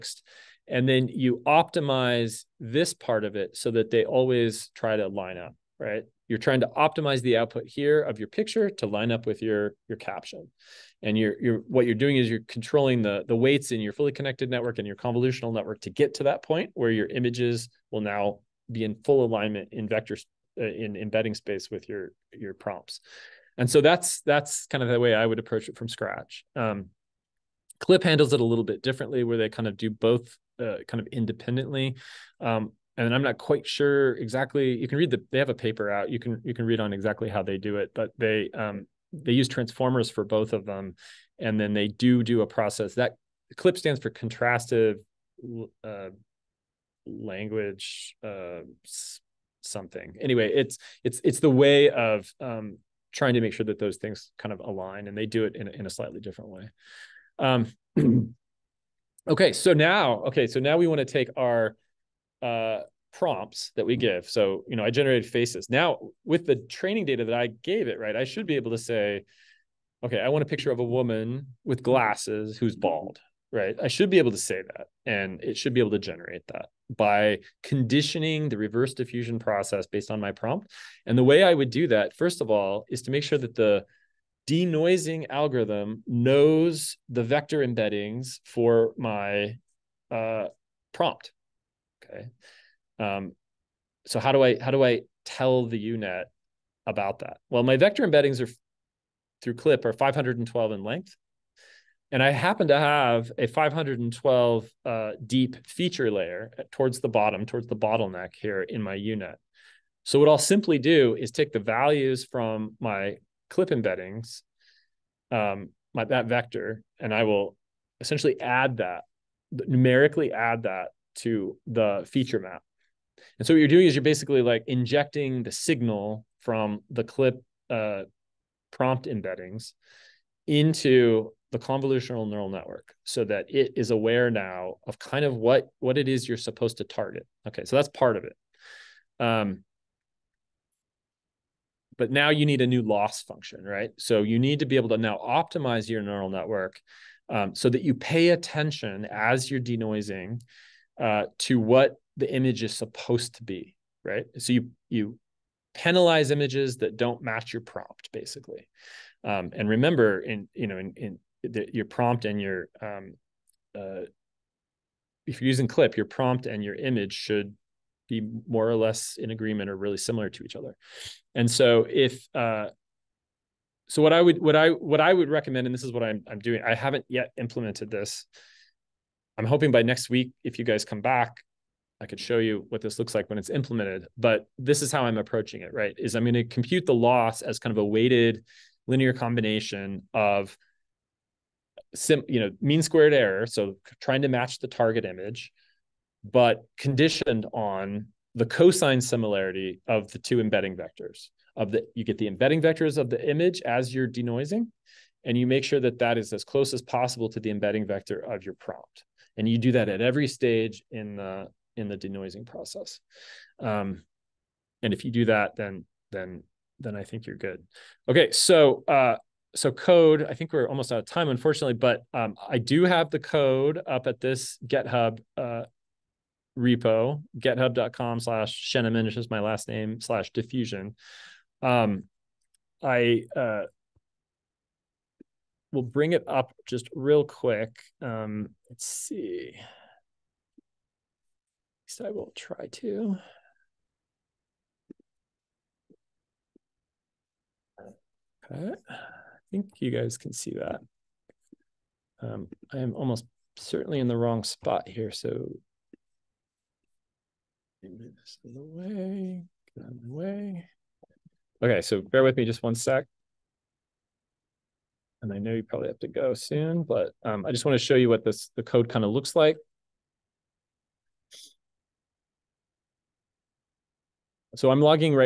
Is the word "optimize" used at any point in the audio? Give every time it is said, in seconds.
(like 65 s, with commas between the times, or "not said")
1 s, 6 s, 145 s.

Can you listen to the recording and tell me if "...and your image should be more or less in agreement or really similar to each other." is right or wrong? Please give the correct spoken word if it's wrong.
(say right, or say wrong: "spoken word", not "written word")
right.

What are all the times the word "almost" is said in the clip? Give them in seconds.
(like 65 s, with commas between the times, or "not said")
220 s, 252 s.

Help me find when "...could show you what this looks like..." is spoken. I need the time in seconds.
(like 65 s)
182 s.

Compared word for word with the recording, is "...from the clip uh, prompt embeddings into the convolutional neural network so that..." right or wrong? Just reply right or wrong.
right.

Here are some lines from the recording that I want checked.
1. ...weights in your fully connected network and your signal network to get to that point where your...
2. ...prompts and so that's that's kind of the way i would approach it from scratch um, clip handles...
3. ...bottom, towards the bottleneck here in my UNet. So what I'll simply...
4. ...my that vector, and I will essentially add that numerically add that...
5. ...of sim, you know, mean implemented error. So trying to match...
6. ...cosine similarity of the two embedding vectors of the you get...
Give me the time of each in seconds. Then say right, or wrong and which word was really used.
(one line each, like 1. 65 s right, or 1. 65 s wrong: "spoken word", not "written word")
1. 13 s wrong: "convolutional", not "signal"
2. 22 s right
3. 107 s right
4. 115 s right
5. 190 s wrong: "squared", not "implemented"
6. 198 s right.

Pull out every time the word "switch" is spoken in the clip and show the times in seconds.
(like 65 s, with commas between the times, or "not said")
not said.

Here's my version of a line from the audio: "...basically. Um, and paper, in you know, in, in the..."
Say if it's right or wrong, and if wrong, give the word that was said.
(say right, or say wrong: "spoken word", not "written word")
wrong: "remember", not "paper".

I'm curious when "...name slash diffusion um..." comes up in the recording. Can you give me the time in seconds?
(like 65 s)
229 s.